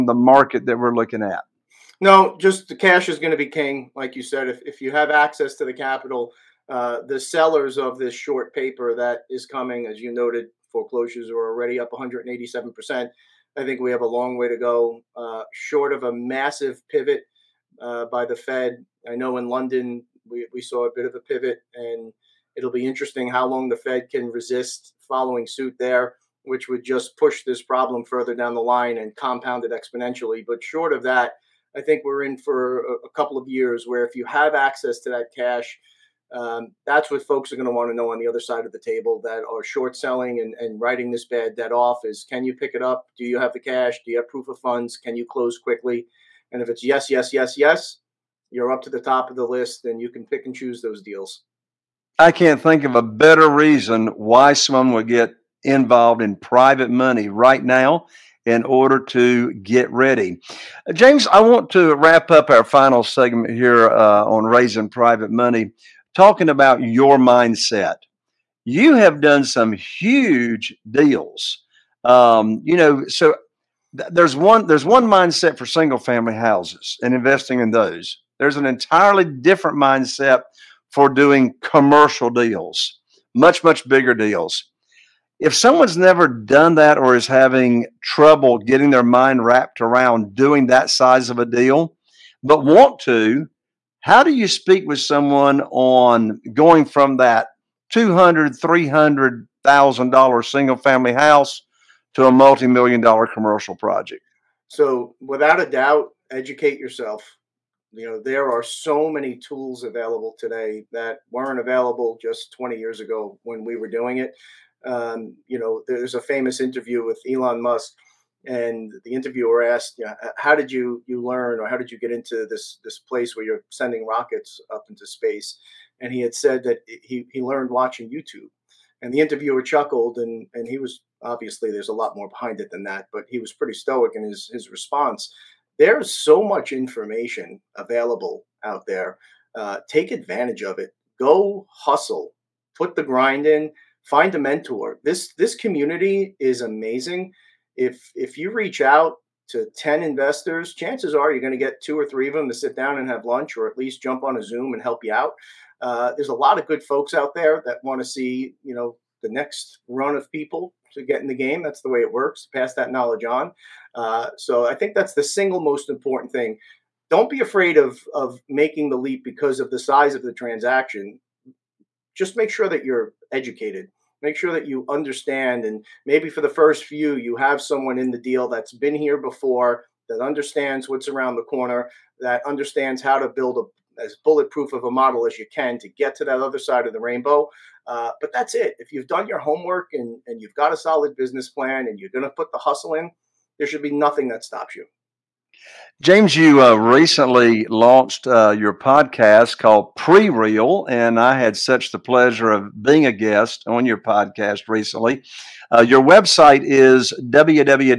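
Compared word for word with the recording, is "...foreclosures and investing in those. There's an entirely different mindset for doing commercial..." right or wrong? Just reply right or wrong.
wrong.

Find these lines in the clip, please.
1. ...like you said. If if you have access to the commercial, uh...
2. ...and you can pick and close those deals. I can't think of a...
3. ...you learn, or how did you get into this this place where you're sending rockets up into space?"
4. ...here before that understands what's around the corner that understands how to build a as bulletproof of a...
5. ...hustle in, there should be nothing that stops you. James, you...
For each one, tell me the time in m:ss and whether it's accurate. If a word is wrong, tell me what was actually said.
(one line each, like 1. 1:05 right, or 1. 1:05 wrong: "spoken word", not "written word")
1. 0:03 wrong: "capital", not "commercial"
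2. 0:49 wrong: "choose", not "close"
3. 2:01 right
4. 2:58 right
5. 3:12 right.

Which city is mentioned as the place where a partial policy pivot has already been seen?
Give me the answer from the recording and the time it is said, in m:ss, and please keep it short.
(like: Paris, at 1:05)
London, at 0:19.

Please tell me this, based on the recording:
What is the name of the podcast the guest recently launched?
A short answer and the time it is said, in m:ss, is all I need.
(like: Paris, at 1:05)
Pre Real, at 3:19.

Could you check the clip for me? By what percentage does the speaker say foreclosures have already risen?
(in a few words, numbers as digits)
187 percent.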